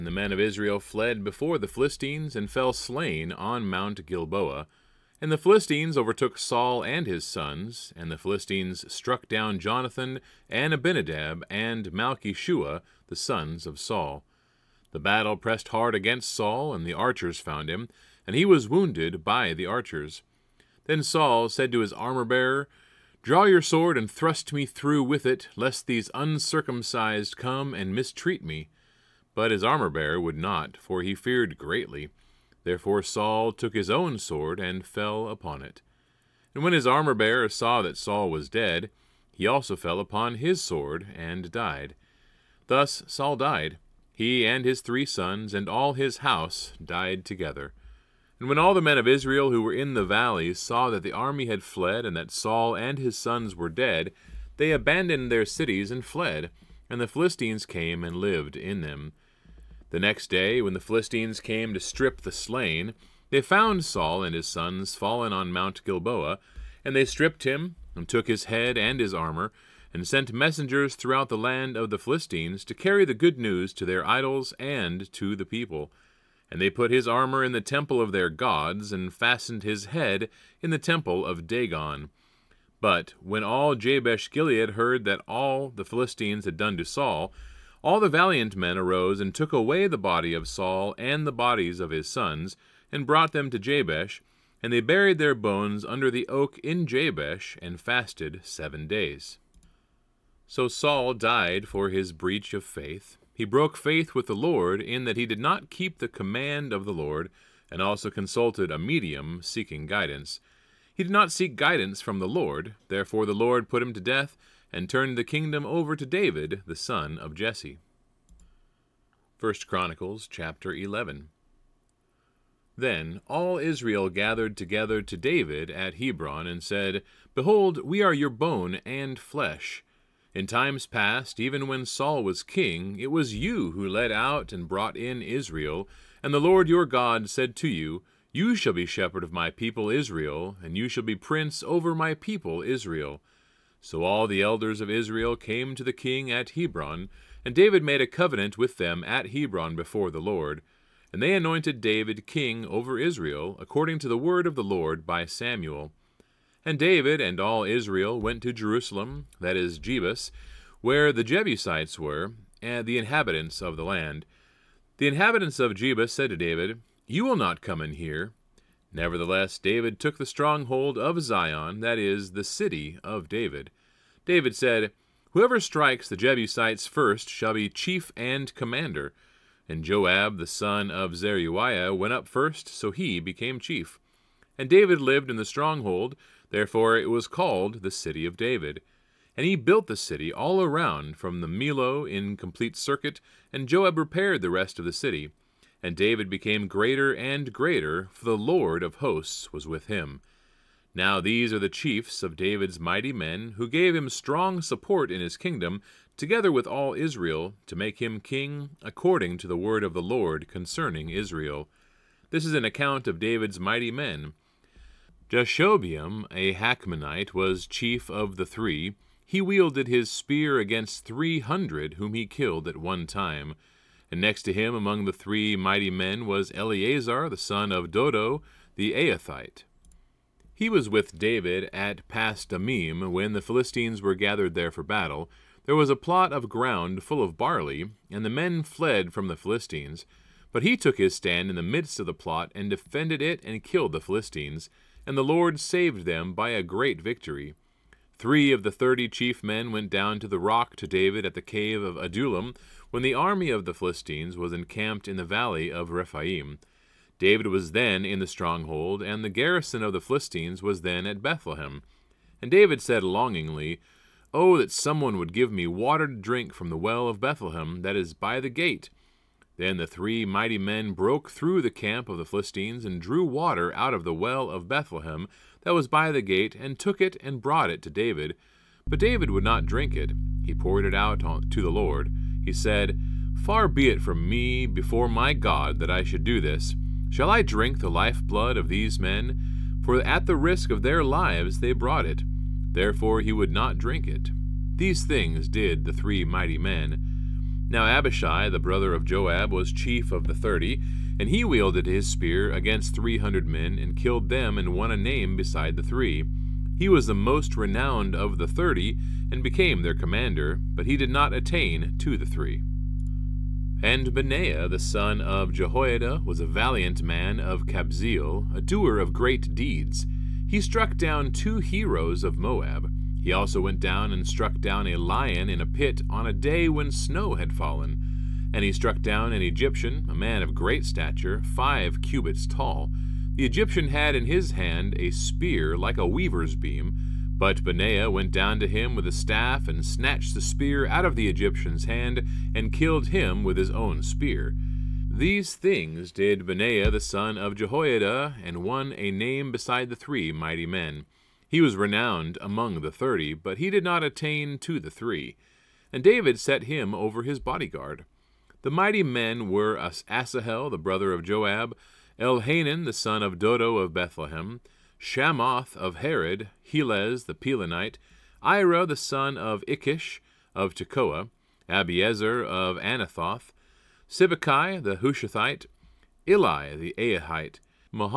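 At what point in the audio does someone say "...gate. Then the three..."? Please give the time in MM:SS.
04:28.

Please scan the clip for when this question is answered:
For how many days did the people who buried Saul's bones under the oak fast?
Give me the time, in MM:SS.
01:38.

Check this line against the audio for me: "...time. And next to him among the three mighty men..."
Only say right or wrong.
right.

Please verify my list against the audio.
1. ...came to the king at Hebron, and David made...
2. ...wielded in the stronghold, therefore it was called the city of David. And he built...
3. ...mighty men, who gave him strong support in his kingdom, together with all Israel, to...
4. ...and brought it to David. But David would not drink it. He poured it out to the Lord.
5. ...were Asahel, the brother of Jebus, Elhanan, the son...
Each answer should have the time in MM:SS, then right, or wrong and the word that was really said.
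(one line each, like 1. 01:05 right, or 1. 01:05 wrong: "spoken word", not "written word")
1. 02:25 right
2. 03:04 wrong: "lived", not "wielded"
3. 03:22 right
4. 04:37 right
5. 05:59 wrong: "Joab", not "Jebus".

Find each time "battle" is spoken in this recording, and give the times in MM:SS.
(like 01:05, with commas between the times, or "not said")
00:14, 03:54.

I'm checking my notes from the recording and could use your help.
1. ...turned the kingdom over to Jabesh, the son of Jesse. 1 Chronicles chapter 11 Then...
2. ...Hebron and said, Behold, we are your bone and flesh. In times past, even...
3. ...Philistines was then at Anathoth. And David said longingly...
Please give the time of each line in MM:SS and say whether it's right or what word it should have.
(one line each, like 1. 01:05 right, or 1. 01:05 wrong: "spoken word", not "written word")
1. 01:54 wrong: "David", not "Jabesh"
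2. 02:05 right
3. 04:20 wrong: "Bethlehem", not "Anathoth".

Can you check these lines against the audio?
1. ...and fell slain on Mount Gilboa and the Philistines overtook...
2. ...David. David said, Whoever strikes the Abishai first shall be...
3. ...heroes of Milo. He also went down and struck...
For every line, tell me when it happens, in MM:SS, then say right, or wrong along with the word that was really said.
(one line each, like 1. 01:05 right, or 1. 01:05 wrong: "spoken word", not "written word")
1. 00:02 right
2. 02:53 wrong: "Jebusites", not "Abishai"
3. 05:21 wrong: "Moab", not "Milo".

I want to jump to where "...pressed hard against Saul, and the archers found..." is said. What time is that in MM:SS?
00:15.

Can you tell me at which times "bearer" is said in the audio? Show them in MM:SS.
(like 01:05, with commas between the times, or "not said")
00:21, 00:29, 00:36.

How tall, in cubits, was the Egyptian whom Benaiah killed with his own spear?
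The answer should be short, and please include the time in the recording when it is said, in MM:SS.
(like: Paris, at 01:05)
5 cubits, at 05:31.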